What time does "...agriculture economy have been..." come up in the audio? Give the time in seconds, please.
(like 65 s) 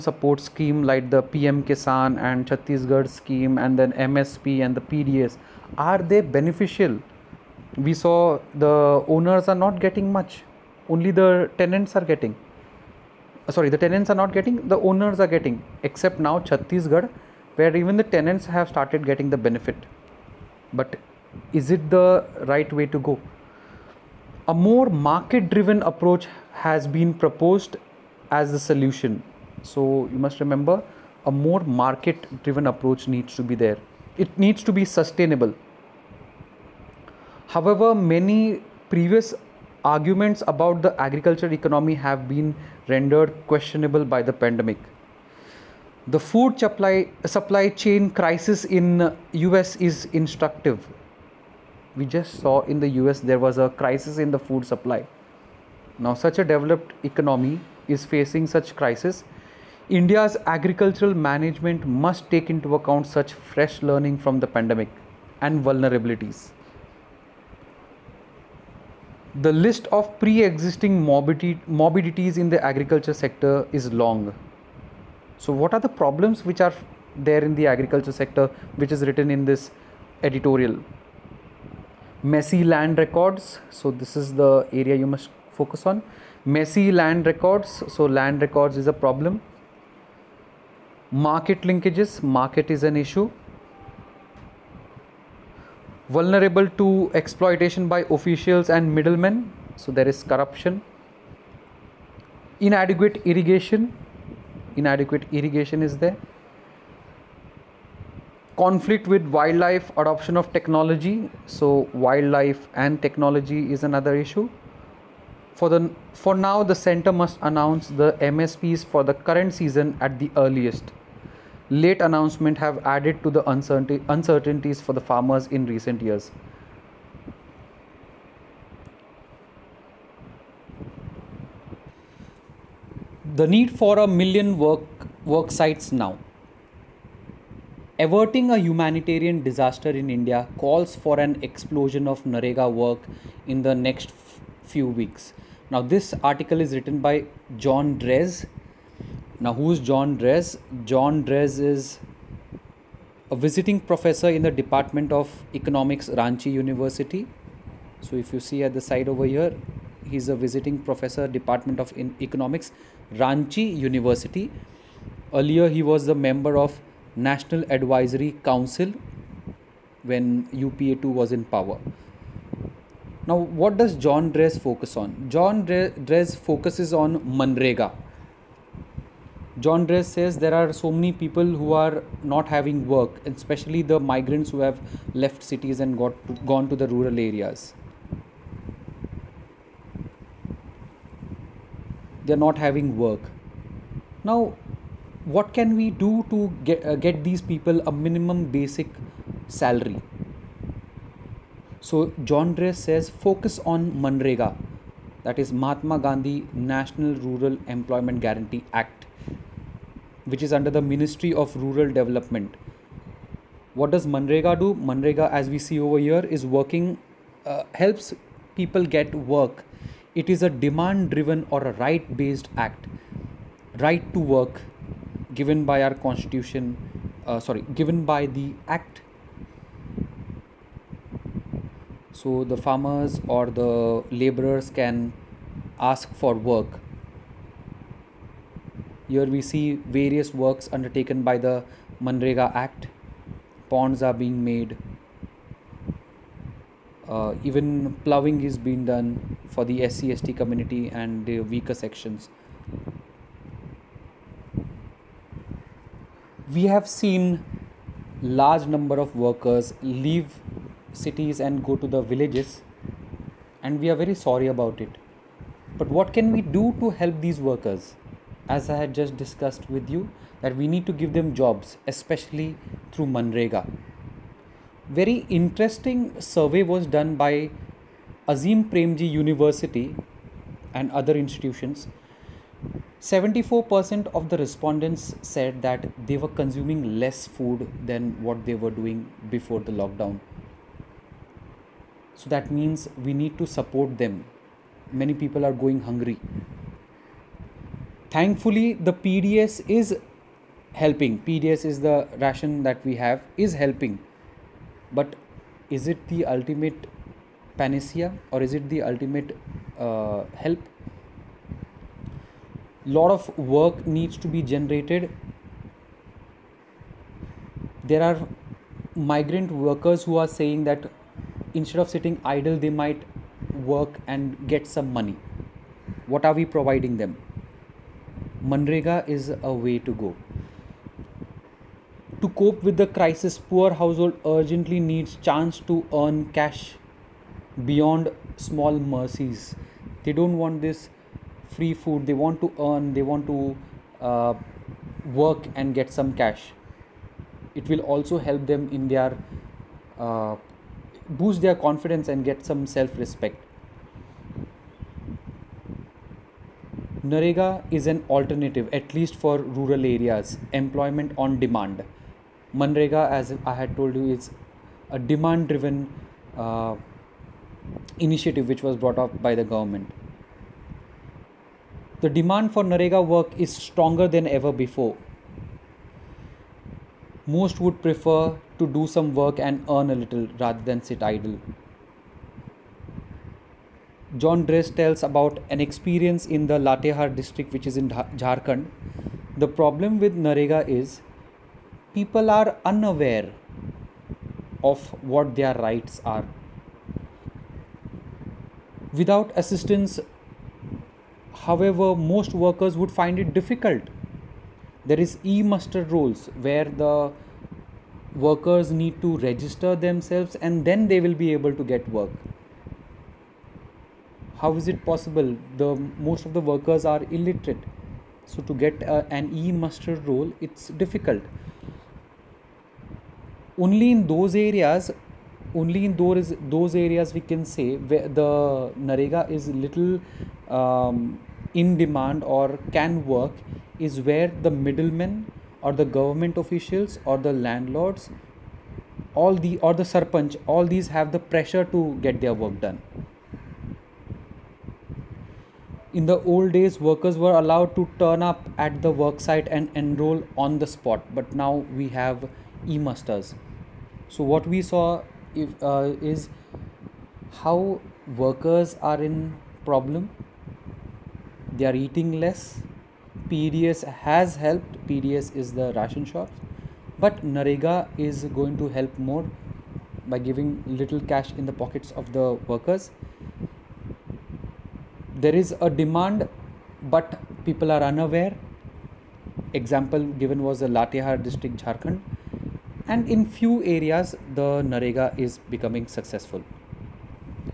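40 s.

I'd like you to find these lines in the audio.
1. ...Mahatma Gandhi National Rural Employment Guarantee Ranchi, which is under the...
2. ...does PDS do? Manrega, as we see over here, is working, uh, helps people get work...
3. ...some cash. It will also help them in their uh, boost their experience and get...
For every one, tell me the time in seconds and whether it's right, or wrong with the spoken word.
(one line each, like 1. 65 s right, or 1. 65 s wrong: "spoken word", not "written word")
1. 205 s wrong: "Act", not "Ranchi"
2. 213 s wrong: "Manrega", not "PDS"
3. 345 s wrong: "confidence", not "experience".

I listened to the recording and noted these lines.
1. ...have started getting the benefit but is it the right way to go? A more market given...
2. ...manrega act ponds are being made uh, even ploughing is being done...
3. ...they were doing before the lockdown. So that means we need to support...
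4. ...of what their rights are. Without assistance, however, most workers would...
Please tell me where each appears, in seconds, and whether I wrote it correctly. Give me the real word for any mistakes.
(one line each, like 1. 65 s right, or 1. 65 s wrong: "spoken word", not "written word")
1. 18 s wrong: "driven", not "given"
2. 242 s right
3. 288 s right
4. 394 s right.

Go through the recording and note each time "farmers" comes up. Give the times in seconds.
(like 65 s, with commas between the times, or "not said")
124 s, 232 s.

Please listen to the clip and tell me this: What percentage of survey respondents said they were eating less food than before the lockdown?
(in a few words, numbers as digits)
74%.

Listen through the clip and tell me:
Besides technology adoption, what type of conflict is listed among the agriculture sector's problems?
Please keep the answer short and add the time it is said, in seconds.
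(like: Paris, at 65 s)
Conflict with wildlife, at 108 s.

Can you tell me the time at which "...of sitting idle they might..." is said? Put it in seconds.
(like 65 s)
321 s.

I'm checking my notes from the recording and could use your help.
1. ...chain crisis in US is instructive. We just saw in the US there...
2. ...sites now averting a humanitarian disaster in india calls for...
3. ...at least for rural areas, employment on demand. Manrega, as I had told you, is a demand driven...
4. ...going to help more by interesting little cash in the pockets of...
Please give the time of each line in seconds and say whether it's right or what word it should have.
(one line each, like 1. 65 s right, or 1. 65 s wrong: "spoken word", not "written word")
1. 47 s right
2. 135 s right
3. 358 s right
4. 468 s wrong: "giving", not "interesting".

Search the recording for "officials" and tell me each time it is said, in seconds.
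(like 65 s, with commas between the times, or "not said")
98 s, 436 s.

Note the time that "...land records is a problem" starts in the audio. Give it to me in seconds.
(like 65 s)
88 s.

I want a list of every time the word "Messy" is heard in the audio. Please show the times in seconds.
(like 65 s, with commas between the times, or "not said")
82 s, 86 s.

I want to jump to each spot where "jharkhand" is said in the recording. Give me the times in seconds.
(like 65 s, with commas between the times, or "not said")
387 s, 481 s.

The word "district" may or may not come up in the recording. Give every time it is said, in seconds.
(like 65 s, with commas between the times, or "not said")
387 s, 481 s.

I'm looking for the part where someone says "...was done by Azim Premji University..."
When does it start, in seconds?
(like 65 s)
276 s.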